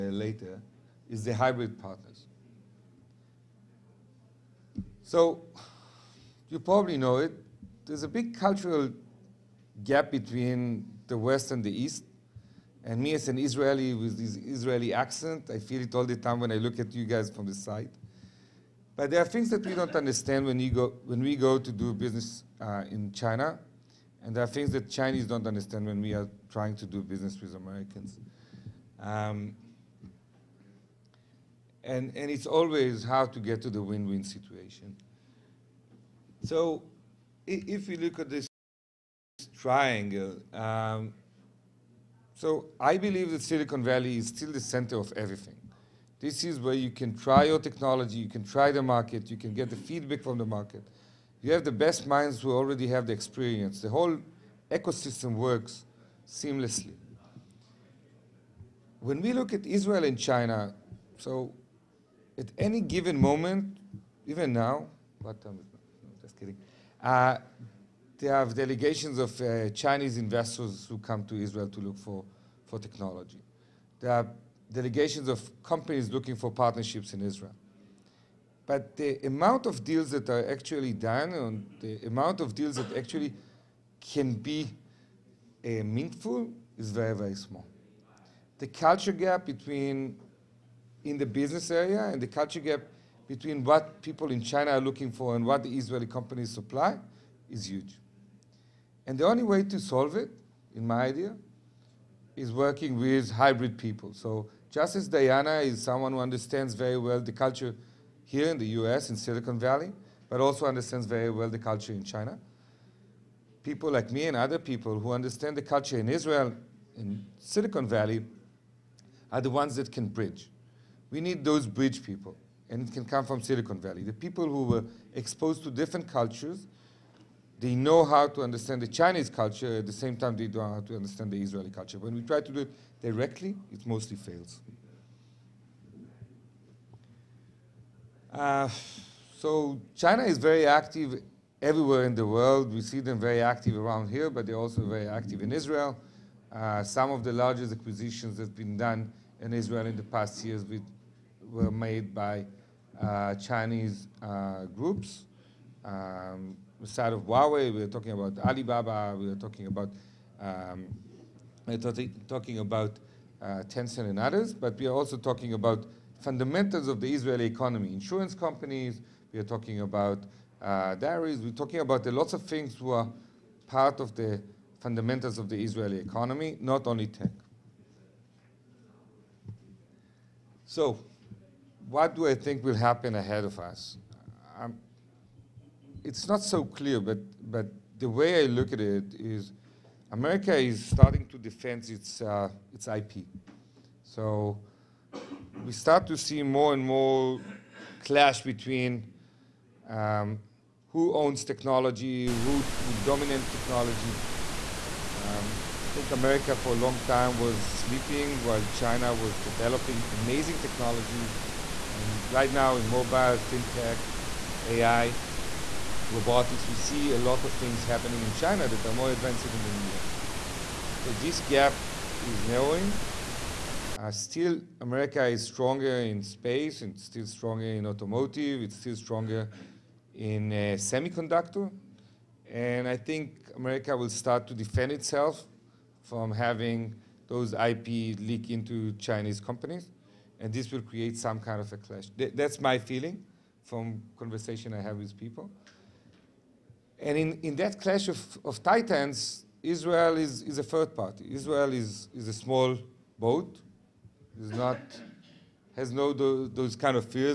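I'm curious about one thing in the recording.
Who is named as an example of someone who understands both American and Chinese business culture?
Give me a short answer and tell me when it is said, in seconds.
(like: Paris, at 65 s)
Diana, at 105 s.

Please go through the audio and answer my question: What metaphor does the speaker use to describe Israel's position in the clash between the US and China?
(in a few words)
A small boat.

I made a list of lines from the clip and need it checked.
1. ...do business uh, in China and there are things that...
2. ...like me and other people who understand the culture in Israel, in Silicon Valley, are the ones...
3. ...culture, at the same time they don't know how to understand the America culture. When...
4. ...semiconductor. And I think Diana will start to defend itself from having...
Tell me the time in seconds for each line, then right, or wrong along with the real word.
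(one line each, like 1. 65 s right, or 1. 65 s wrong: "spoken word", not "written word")
1. 21 s right
2. 113 s right
3. 129 s wrong: "Israeli", not "America"
4. 230 s wrong: "America", not "Diana".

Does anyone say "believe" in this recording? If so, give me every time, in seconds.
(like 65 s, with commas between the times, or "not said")
42 s.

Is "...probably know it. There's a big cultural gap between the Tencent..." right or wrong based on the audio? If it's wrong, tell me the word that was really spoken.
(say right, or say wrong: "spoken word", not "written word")
wrong: "West", not "Tencent".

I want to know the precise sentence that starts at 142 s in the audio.
We see them very active around here, but they're also very active in Israel.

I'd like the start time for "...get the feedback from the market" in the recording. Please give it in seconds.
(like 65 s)
49 s.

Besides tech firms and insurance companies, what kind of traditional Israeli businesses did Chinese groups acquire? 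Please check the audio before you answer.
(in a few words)
Dairies.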